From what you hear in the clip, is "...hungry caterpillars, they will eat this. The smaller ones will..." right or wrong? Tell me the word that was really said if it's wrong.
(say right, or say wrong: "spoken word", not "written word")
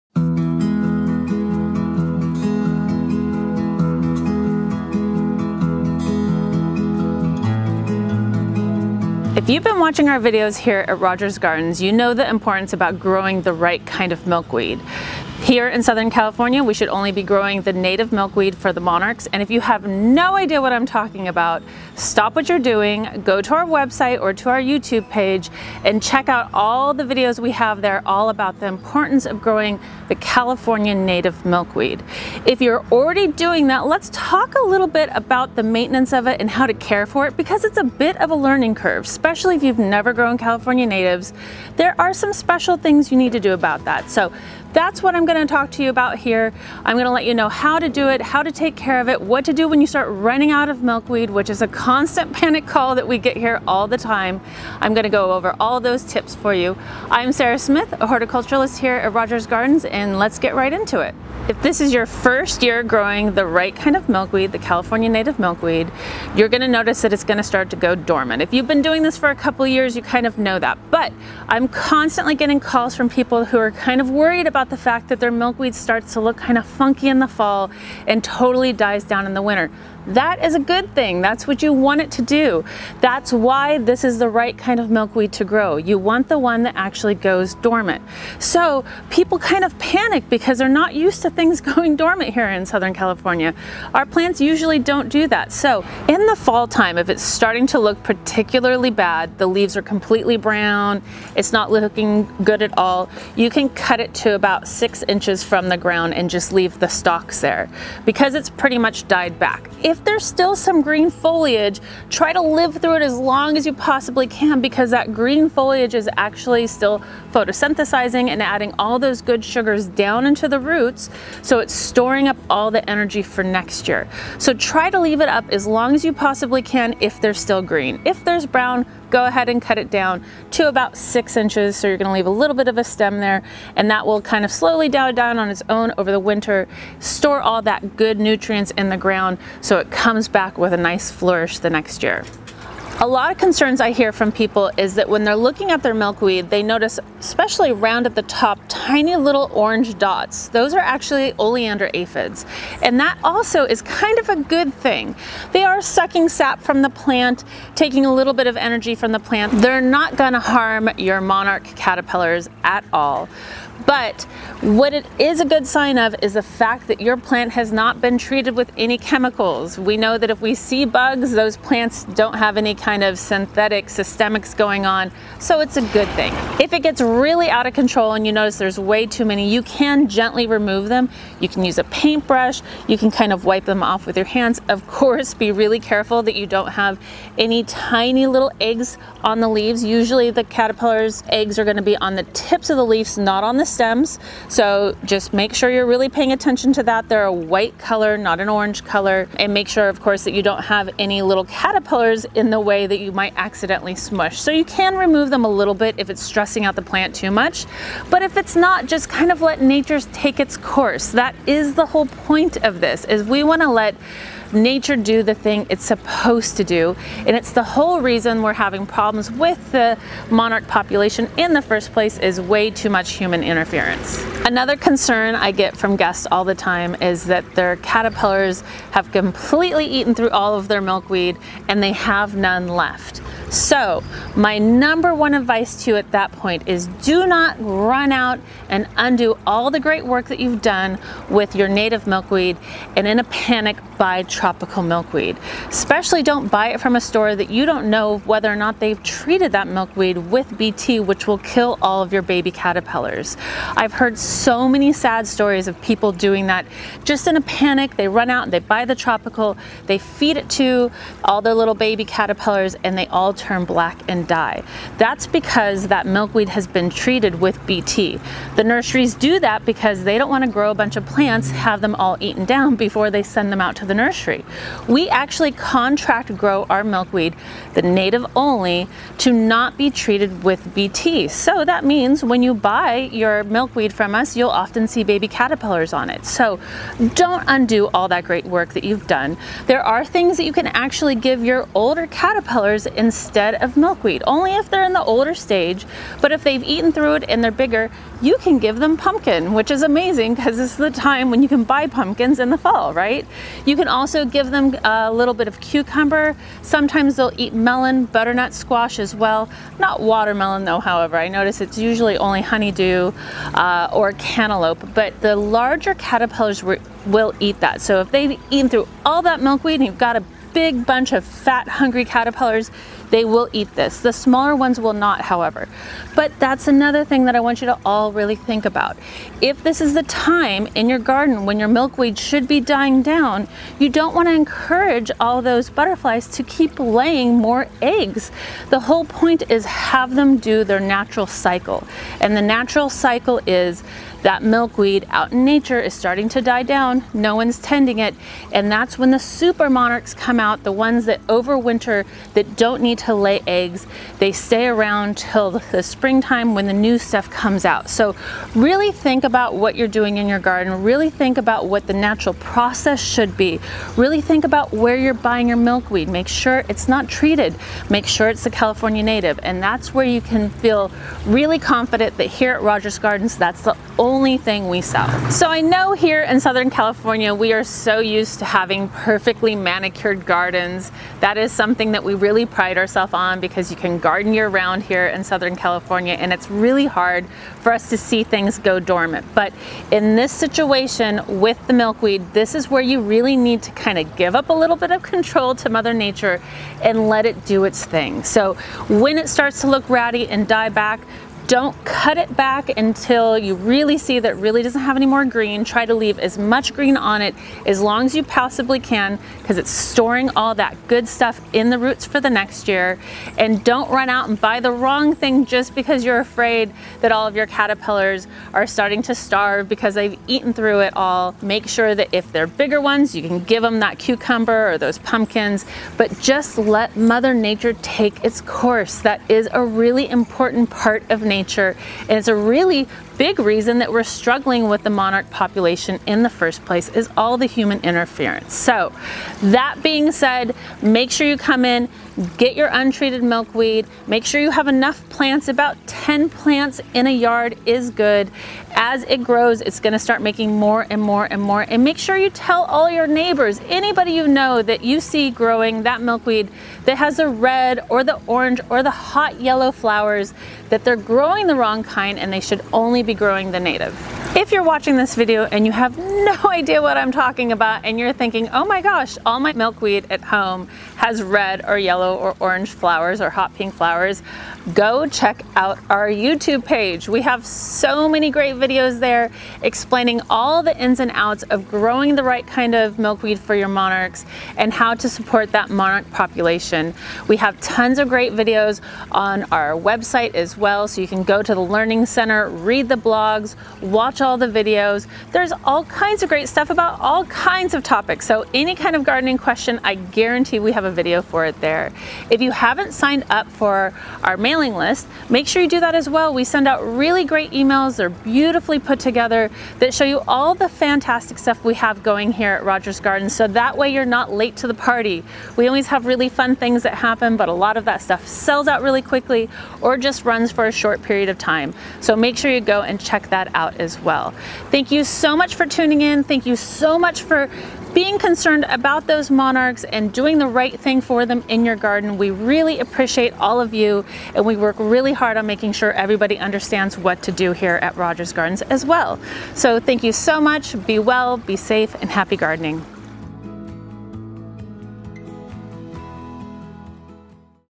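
right.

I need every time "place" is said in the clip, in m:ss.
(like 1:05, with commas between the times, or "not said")
3:41, 7:16.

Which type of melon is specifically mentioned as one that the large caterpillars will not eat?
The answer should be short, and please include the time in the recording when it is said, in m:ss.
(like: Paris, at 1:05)
watermelon, at 5:10.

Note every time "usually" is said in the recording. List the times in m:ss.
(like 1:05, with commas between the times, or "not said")
1:34, 3:09, 5:11.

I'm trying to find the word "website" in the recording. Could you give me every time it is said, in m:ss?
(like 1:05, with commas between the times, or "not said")
0:23, 8:09.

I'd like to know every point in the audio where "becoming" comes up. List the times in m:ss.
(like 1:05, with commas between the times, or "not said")
not said.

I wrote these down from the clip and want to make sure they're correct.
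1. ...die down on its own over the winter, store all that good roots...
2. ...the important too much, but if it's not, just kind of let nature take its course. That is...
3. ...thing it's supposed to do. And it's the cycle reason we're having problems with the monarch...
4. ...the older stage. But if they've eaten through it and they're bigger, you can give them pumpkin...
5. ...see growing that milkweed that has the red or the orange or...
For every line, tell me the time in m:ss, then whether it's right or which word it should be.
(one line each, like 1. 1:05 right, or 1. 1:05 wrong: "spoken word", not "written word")
1. 2:14 wrong: "nutrients", not "roots"
2. 3:26 wrong: "plant", not "important"
3. 3:35 wrong: "whole", not "cycle"
4. 4:54 right
5. 7:34 right.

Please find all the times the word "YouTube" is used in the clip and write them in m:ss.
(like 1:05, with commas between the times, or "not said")
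0:24, 7:56.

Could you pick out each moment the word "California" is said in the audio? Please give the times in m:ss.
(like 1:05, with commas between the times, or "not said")
0:16, 0:30, 0:40, 1:04, 1:32, 6:08, 6:16, 6:25.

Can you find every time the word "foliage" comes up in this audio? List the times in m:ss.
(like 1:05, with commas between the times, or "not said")
1:51, 1:55.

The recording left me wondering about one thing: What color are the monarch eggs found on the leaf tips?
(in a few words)
white.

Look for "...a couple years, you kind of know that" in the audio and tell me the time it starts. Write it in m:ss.
1:09.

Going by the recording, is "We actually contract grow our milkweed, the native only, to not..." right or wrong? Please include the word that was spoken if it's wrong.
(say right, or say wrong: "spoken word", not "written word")
right.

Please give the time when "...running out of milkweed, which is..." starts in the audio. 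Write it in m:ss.
0:50.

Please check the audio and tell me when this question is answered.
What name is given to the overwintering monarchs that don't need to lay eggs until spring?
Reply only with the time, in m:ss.
5:49.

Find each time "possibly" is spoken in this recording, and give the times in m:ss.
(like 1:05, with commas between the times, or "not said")
1:53, 2:06, 6:48.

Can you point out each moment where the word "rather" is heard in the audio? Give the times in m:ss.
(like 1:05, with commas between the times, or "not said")
not said.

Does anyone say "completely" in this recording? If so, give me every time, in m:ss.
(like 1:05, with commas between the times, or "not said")
1:39, 3:49.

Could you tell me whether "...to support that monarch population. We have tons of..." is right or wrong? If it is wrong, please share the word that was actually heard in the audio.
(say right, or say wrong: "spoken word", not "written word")
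right.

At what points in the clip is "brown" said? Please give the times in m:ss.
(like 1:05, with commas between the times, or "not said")
1:40, 2:08.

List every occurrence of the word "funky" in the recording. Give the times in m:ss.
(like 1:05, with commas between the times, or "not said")
1:16.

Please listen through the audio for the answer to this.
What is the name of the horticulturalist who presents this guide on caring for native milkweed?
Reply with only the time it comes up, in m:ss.
0:57.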